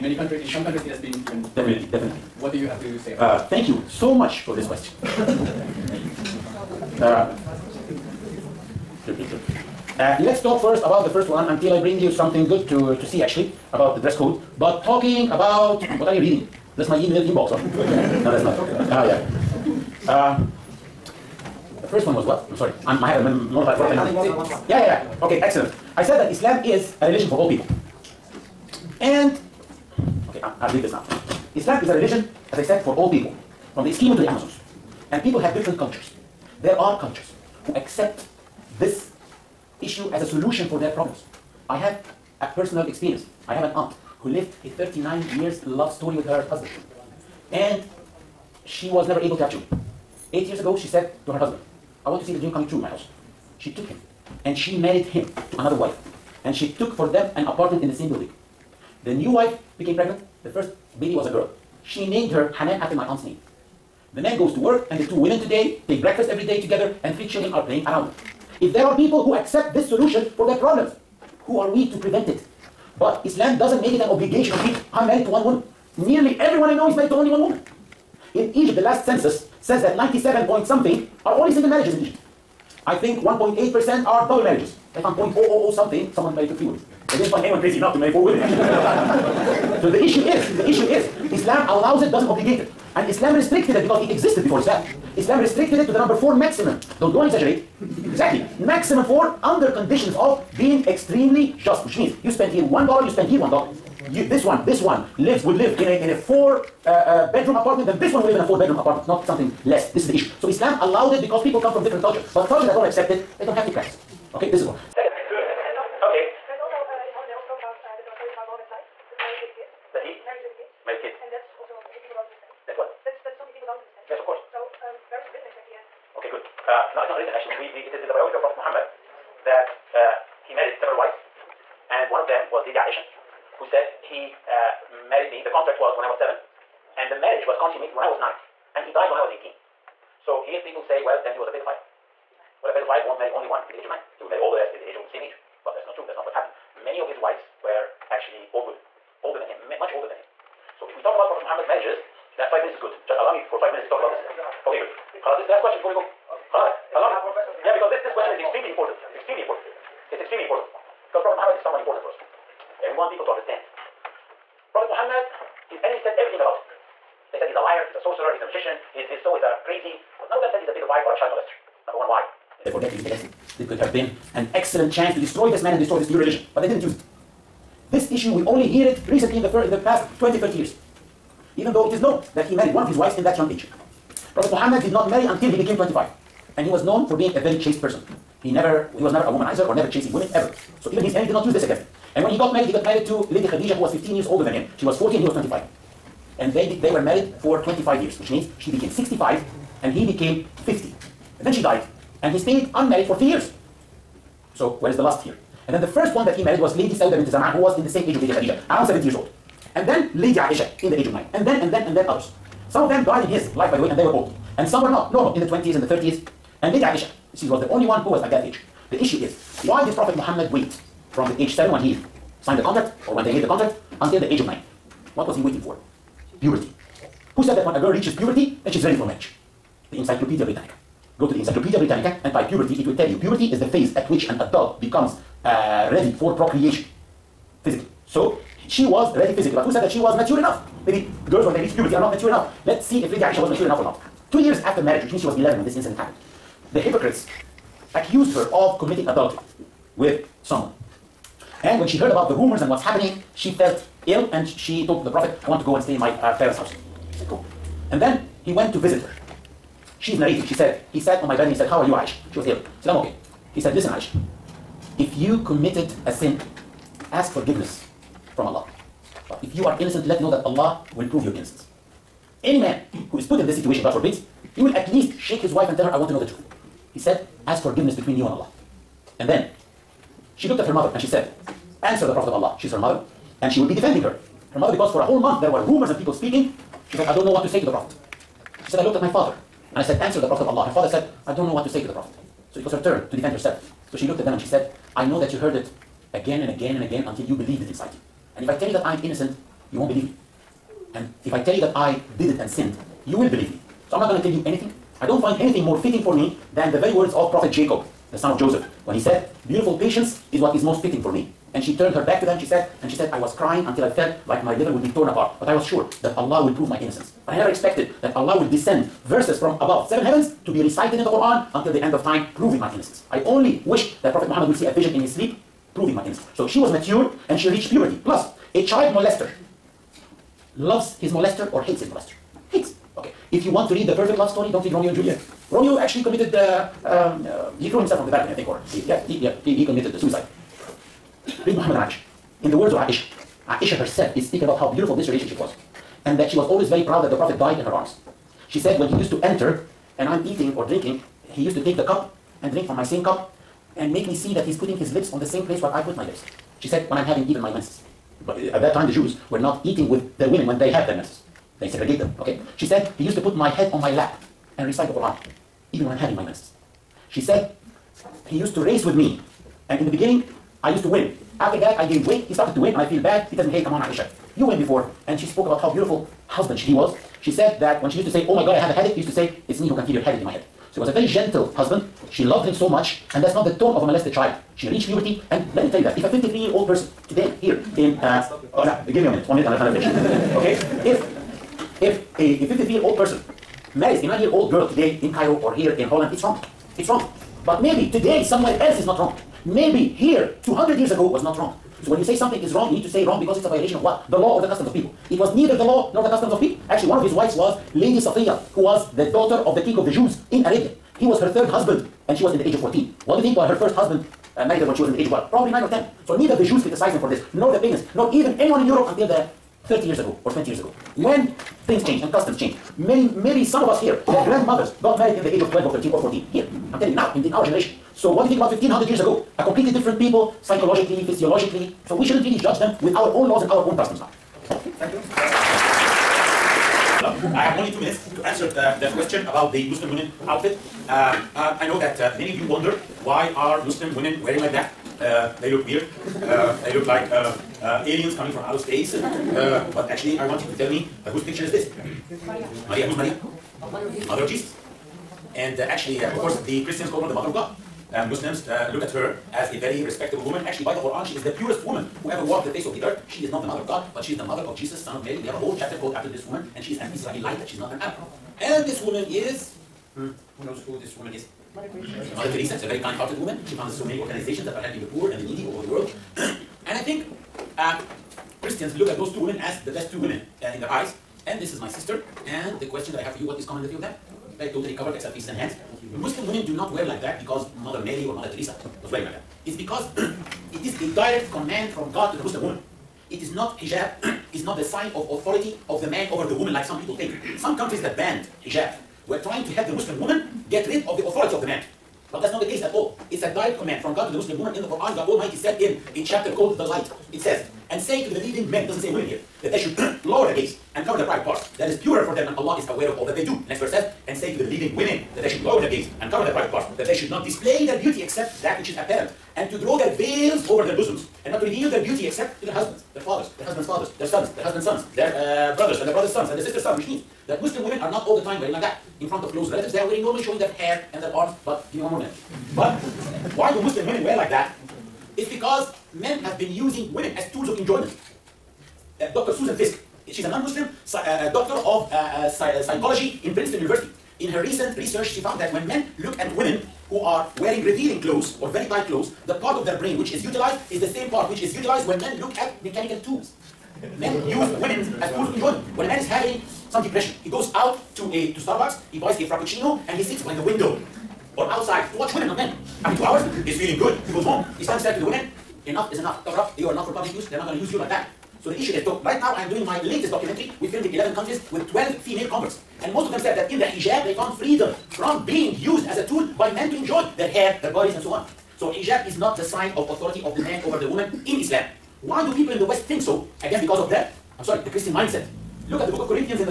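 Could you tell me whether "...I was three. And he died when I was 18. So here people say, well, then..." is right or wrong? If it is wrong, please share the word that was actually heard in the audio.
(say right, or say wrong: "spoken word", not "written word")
wrong: "nine", not "three".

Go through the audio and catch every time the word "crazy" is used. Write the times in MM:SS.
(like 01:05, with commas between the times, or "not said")
01:27, 02:49.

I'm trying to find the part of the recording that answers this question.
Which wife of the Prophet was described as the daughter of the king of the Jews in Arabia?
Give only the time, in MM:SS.
06:47.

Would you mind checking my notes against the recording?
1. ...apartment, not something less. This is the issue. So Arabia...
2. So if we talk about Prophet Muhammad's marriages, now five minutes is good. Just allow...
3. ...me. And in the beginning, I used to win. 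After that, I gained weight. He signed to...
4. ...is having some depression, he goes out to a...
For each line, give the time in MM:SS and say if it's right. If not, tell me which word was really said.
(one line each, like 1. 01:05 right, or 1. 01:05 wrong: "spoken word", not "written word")
1. 01:48 wrong: "Islam", not "Arabia"
2. 02:30 right
3. 06:08 wrong: "started", not "signed"
4. 09:15 right.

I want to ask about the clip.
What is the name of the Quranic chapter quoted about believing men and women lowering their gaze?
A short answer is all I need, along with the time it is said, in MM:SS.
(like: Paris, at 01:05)
The Light, at 08:26.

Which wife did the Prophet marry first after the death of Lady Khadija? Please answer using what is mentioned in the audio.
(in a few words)
Sauda bint Zam'a.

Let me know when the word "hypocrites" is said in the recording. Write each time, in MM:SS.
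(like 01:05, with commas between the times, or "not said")
04:06.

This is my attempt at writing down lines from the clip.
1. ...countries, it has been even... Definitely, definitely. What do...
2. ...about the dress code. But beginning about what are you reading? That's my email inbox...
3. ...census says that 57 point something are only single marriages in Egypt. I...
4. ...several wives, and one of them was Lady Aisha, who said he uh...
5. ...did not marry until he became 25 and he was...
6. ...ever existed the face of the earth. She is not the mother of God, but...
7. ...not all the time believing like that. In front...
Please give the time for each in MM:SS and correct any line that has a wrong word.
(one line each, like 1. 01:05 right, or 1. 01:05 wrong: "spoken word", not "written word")
1. 00:00 right
2. 00:13 wrong: "talking", not "beginning"
3. 01:19 wrong: "97", not "57"
4. 02:10 right
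5. 03:04 right
6. 07:42 wrong: "walked", not "existed"
7. 08:47 wrong: "wearing", not "believing".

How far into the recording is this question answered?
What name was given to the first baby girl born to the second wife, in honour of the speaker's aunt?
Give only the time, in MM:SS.
01:02.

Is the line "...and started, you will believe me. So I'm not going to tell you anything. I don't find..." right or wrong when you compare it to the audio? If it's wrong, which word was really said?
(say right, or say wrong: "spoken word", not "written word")
wrong: "sinned", not "started".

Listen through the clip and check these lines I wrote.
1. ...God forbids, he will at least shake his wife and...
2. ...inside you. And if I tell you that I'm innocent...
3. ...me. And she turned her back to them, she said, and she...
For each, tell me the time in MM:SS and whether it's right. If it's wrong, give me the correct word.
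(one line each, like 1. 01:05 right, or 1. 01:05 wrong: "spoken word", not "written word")
1. 04:33 right
2. 04:57 right
3. 05:11 right.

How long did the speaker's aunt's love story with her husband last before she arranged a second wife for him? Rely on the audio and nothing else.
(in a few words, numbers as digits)
39 years.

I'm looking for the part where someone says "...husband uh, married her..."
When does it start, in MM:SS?
06:53.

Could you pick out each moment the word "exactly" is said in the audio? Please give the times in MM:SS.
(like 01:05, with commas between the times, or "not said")
01:37, 02:05.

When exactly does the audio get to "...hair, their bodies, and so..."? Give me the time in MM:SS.
09:37.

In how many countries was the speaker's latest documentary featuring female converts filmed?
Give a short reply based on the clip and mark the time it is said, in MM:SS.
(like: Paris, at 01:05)
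11, at 09:30.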